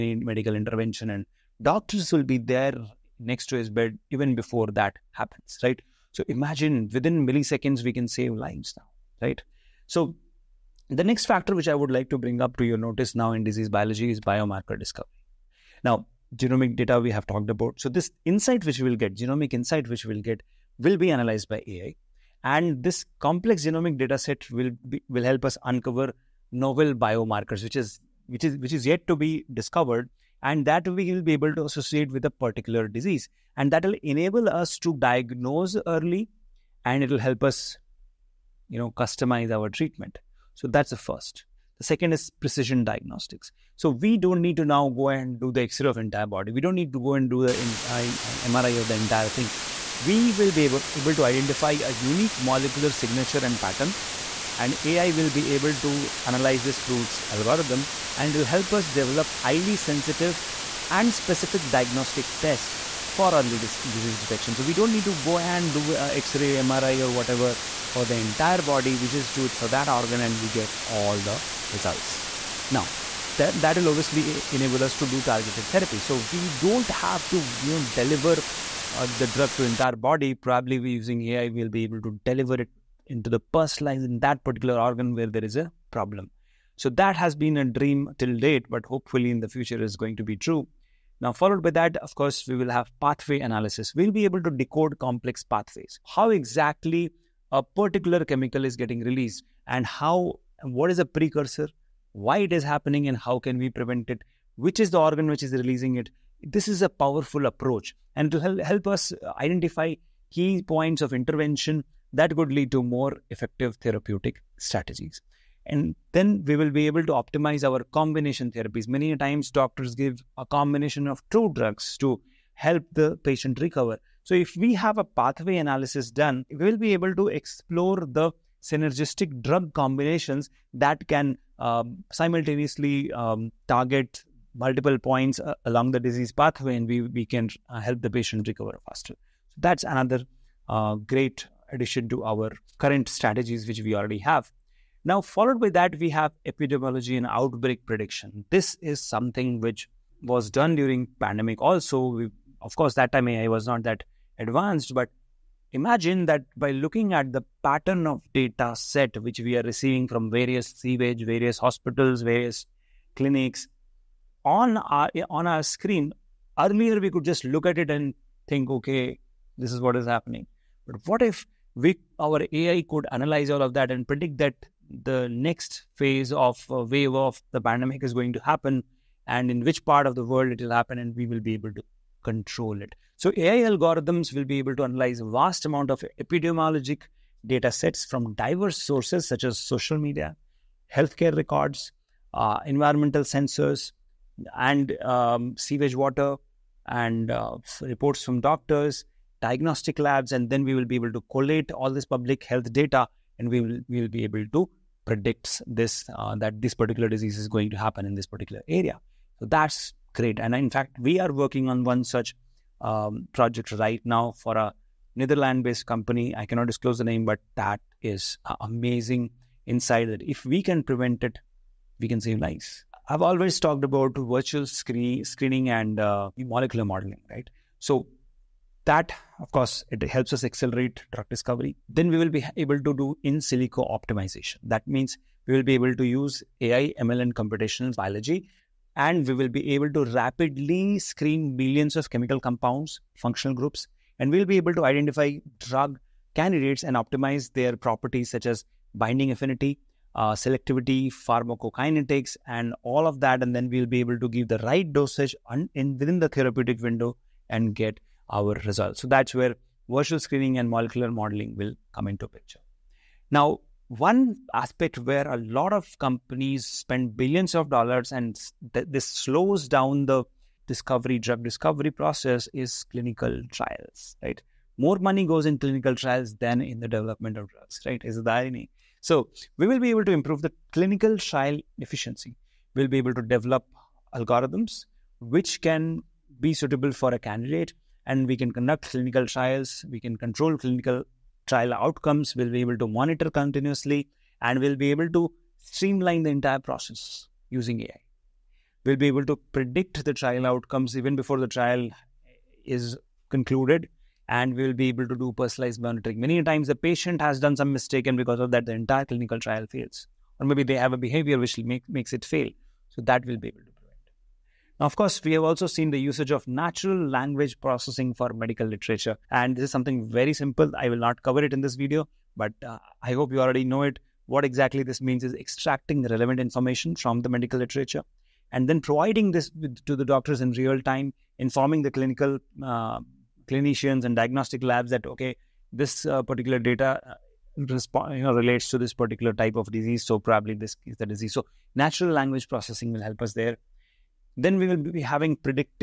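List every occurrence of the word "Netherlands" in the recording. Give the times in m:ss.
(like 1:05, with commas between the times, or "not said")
3:35.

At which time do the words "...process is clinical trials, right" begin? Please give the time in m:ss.
4:31.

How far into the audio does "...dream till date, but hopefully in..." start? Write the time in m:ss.
1:27.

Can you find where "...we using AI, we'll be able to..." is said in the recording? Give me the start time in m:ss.
1:20.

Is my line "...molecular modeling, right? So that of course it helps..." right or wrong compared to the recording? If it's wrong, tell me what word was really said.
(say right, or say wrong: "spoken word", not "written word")
right.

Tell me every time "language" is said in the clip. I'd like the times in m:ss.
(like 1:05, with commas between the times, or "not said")
5:17, 5:42.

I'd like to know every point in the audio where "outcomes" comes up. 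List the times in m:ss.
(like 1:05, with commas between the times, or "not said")
4:51, 5:00.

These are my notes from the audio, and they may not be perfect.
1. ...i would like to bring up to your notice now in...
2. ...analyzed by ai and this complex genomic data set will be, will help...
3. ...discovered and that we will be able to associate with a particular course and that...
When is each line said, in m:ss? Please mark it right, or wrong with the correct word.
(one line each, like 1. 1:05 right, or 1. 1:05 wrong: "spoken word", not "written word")
1. 0:11 right
2. 0:21 right
3. 0:29 wrong: "disease", not "course".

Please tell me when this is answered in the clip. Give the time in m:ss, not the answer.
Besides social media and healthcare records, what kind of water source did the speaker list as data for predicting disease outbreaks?
3:15.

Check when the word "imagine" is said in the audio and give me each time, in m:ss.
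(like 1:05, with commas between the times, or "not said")
0:06, 2:35.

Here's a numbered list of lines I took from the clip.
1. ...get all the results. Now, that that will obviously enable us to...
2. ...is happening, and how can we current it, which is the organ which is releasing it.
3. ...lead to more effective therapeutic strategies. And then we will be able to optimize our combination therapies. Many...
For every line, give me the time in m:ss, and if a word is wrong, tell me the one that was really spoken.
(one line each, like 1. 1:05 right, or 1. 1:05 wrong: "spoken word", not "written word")
1. 1:10 right
2. 1:42 wrong: "prevent", not "current"
3. 1:52 right.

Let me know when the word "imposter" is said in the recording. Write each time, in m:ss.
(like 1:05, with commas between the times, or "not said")
not said.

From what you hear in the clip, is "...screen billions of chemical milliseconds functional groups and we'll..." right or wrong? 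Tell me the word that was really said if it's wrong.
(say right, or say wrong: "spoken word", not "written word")
wrong: "compounds", not "milliseconds".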